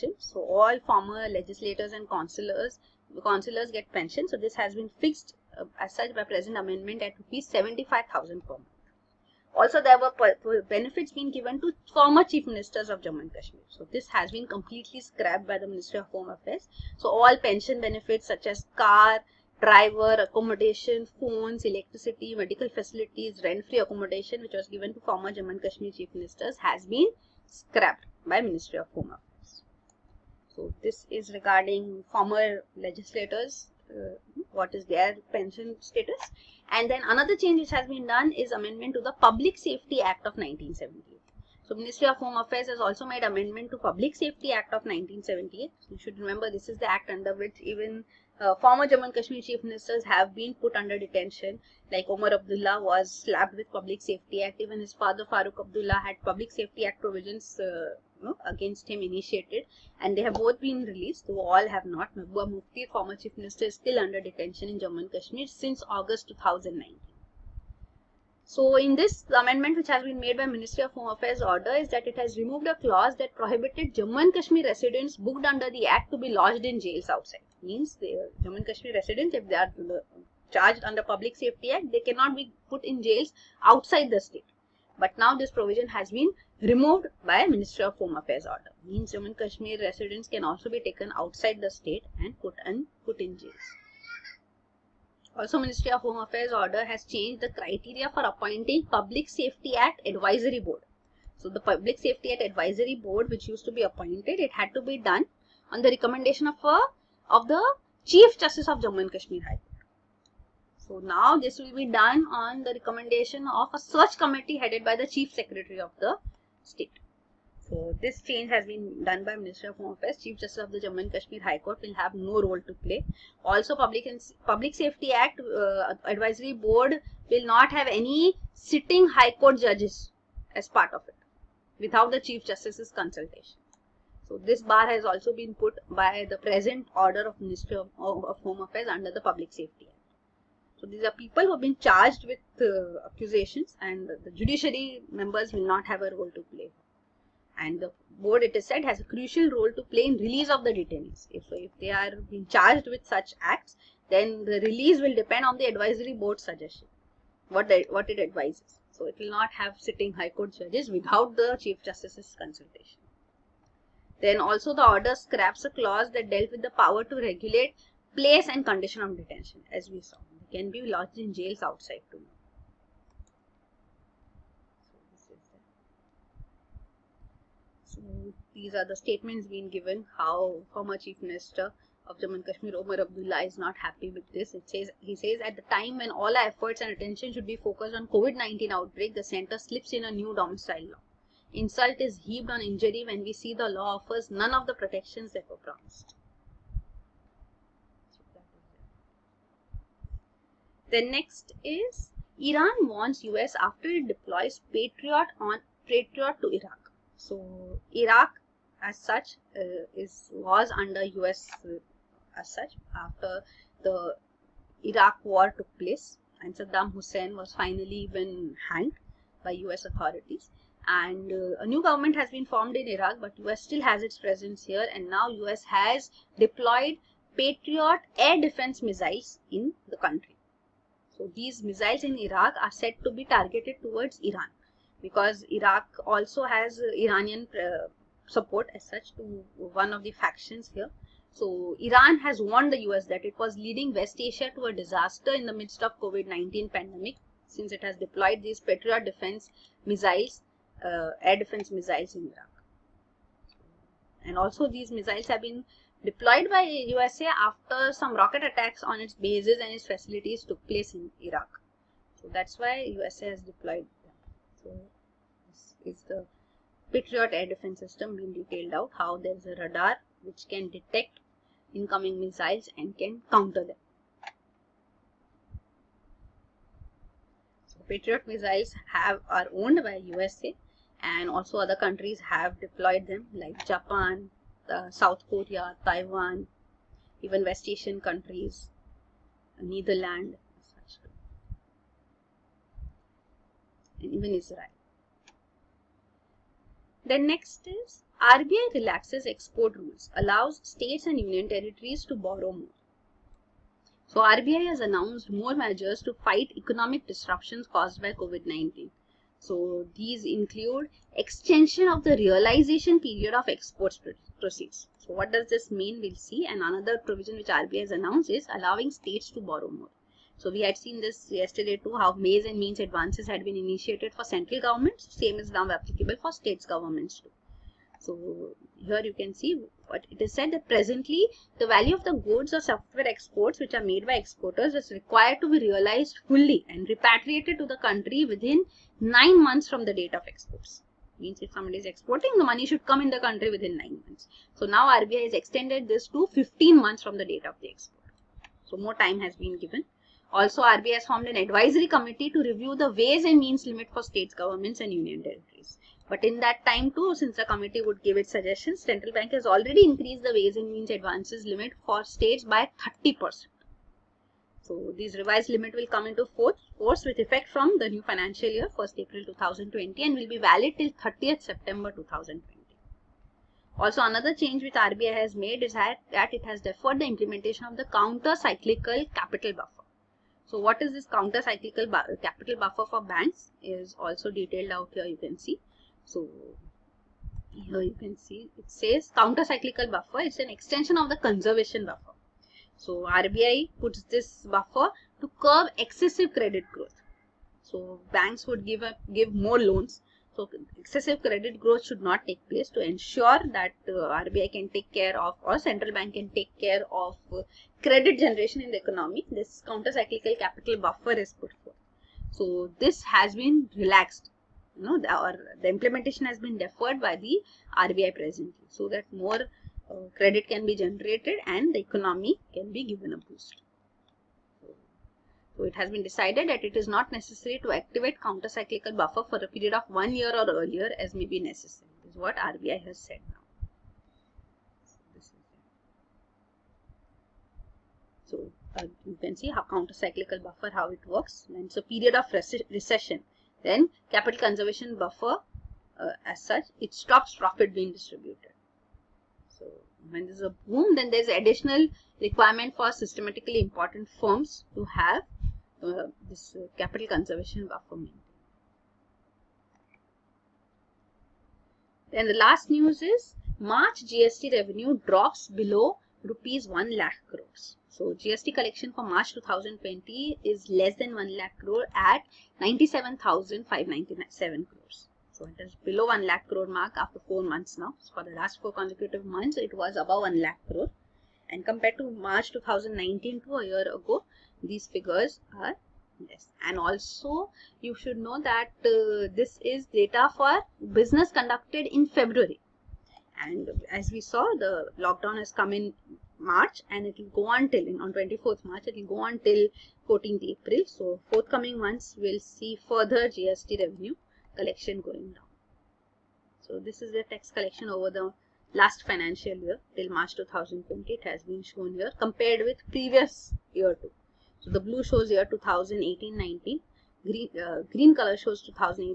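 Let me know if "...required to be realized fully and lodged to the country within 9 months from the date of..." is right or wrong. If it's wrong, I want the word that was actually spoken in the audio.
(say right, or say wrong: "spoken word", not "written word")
wrong: "repatriated", not "lodged".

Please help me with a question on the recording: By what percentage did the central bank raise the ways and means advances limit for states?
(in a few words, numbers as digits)
30%.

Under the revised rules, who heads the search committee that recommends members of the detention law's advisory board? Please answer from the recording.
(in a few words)
Chief Secretary.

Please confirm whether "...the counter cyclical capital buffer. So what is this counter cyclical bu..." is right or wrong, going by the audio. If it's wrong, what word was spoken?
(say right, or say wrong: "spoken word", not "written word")
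right.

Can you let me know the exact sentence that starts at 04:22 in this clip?
So that's why USA has deployed them.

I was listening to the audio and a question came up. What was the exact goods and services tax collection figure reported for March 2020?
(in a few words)
97,597 crores.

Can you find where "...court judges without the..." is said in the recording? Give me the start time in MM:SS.
02:40.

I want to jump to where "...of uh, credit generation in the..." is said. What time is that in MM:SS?
06:46.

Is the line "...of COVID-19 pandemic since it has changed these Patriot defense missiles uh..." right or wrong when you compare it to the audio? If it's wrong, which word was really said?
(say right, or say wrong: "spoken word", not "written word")
wrong: "deployed", not "changed".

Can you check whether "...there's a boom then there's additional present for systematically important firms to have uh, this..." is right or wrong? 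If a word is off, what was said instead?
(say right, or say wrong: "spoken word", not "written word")
wrong: "requirement", not "present".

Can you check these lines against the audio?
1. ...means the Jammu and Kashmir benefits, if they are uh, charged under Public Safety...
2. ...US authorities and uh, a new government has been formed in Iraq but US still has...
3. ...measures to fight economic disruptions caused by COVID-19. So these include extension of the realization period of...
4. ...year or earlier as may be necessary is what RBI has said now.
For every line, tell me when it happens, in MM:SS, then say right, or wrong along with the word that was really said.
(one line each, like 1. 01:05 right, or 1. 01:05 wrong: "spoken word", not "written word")
1. 01:17 wrong: "residents", not "benefits"
2. 03:39 right
3. 05:05 right
4. 07:10 right.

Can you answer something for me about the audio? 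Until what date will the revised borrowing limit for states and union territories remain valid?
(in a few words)
30 September 2020.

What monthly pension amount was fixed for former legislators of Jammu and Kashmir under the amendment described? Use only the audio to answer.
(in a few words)
Rs 75,000.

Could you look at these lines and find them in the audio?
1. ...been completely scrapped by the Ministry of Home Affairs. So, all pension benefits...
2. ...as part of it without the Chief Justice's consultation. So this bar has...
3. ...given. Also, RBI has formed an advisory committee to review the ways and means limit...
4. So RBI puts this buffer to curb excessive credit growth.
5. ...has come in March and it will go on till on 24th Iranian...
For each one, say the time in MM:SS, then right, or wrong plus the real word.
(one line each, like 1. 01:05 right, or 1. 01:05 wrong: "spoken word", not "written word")
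1. 00:14 right
2. 02:10 right
3. 05:49 right
4. 06:32 right
5. 08:15 wrong: "March", not "Iranian".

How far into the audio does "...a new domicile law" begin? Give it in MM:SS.
03:10.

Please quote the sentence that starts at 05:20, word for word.
So we had seen this yesterday too, how ways and means advances had been initiated for central governments.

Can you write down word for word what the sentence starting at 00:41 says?
So Ministry of Home Affairs has also made amendment to Public Safety Act of 1978.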